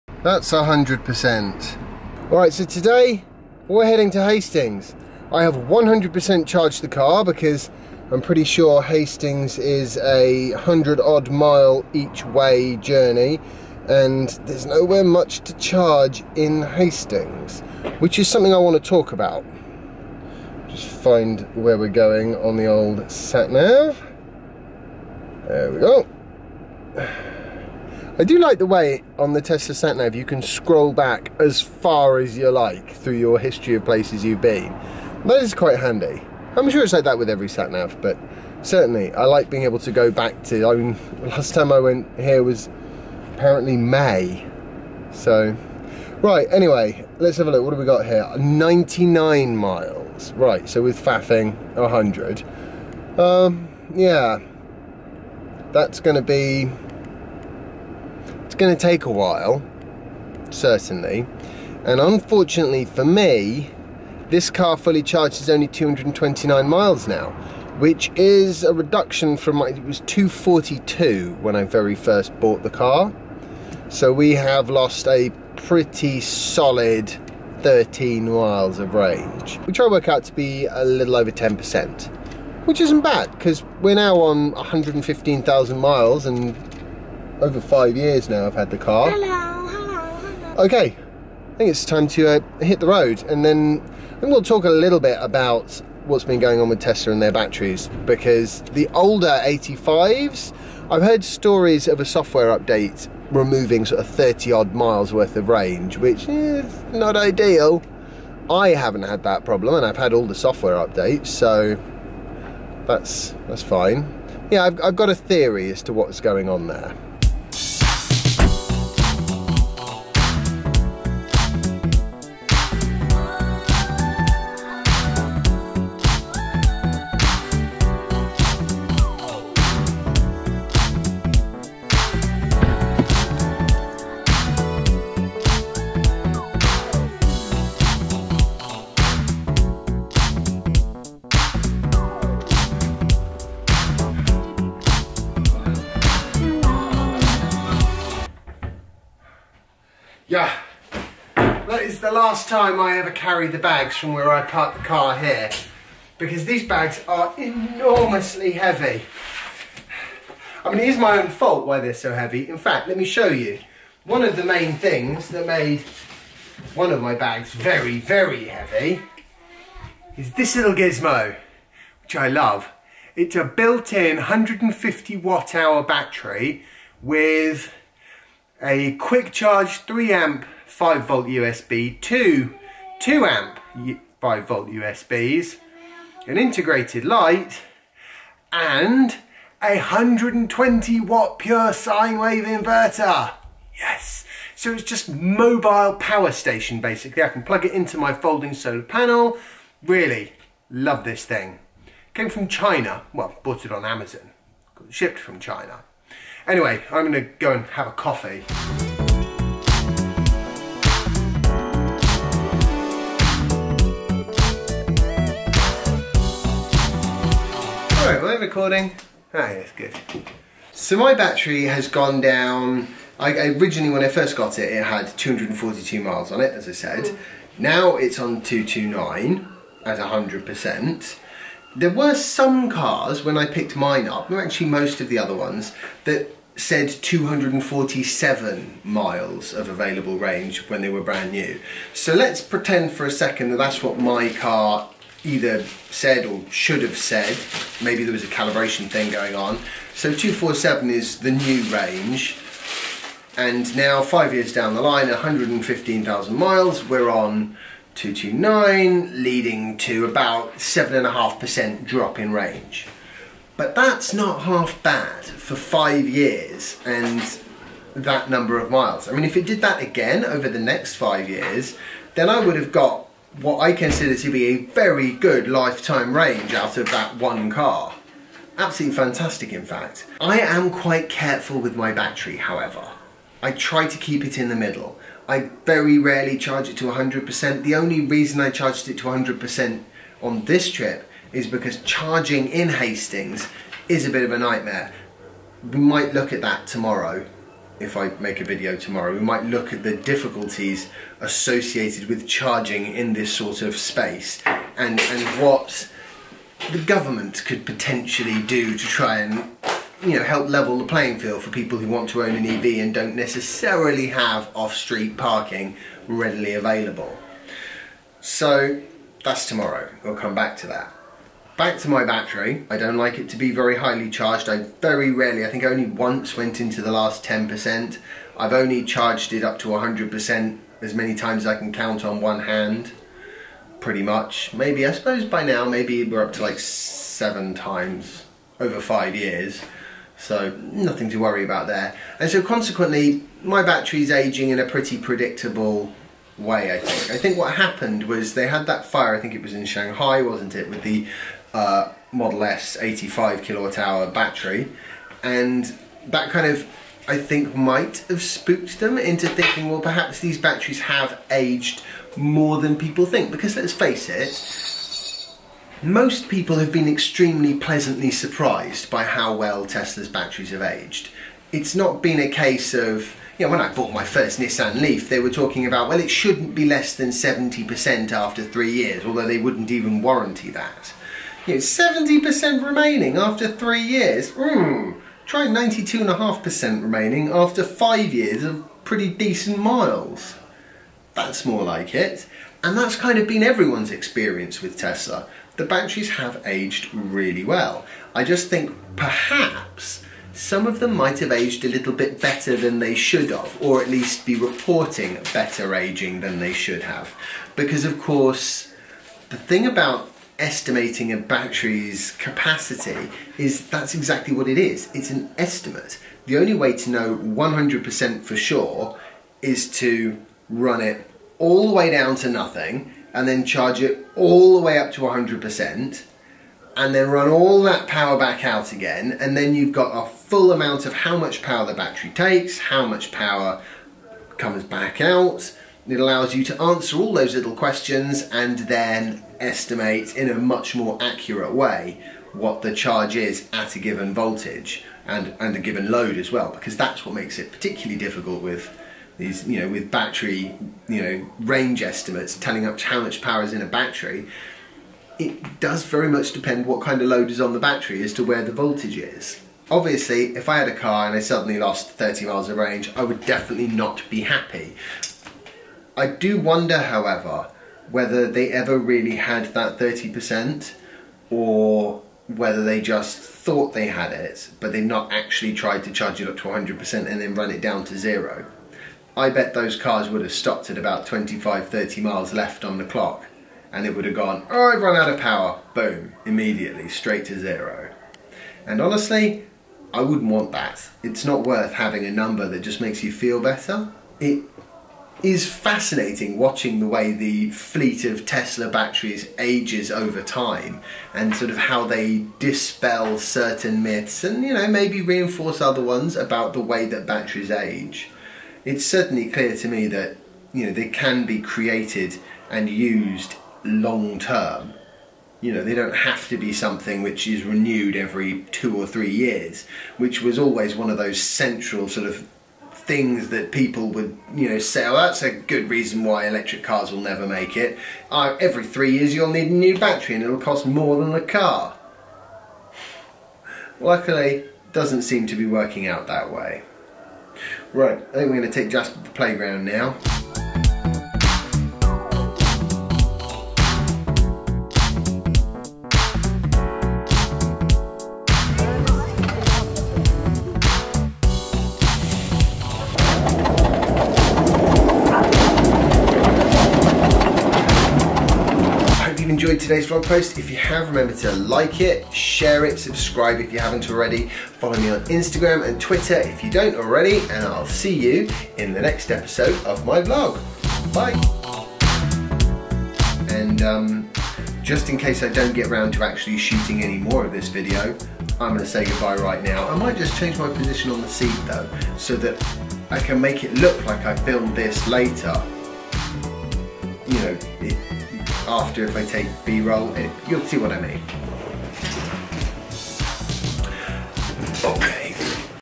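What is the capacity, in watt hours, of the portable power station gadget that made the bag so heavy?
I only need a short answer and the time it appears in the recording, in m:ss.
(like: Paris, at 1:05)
150 watt hours, at 2:54.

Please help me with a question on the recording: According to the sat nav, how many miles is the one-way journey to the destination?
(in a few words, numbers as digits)
99.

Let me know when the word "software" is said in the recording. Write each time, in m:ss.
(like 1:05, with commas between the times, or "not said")
1:42, 1:50.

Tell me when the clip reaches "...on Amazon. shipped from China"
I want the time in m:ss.
3:23.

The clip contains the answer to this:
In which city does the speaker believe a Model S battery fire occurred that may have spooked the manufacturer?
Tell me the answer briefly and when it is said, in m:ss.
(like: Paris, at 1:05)
Shanghai, at 5:49.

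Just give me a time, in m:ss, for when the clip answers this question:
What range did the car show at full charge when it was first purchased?
1:09.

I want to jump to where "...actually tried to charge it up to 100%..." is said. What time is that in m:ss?
7:55.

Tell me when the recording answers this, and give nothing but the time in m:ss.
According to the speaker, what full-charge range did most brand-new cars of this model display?
3:57.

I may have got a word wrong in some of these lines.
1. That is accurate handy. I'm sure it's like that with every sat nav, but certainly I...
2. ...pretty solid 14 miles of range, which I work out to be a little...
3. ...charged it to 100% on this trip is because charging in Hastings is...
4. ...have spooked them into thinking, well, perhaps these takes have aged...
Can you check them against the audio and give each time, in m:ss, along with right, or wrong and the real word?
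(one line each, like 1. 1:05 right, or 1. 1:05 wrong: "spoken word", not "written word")
1. 0:35 wrong: "quite", not "accurate"
2. 1:15 wrong: "13", not "14"
3. 4:48 right
4. 5:58 wrong: "batteries", not "takes".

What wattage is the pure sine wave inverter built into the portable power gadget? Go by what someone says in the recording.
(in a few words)
120 watts.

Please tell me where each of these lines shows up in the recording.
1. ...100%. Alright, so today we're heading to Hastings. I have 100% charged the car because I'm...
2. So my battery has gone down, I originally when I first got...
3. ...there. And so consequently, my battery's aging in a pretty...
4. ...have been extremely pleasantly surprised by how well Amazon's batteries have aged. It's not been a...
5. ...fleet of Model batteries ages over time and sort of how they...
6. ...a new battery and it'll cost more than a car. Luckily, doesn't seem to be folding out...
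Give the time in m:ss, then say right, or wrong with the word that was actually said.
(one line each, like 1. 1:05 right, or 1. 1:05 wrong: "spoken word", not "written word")
1. 0:00 right
2. 3:40 right
3. 5:41 right
4. 6:06 wrong: "Tesla", not "Amazon"
5. 8:17 wrong: "Tesla", not "Model"
6. 8:49 wrong: "working", not "folding".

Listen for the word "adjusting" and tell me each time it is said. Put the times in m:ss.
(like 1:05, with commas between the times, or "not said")
not said.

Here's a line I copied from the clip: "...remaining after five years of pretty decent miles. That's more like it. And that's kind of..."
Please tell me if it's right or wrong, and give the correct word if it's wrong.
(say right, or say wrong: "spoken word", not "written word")
right.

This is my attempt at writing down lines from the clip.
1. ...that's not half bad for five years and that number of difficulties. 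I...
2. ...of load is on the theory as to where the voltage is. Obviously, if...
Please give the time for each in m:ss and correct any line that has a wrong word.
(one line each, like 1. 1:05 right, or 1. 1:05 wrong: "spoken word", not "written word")
1. 4:23 wrong: "miles", not "difficulties"
2. 7:37 wrong: "battery", not "theory".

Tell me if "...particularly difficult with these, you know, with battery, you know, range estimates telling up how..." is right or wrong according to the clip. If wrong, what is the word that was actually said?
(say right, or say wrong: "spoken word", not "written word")
right.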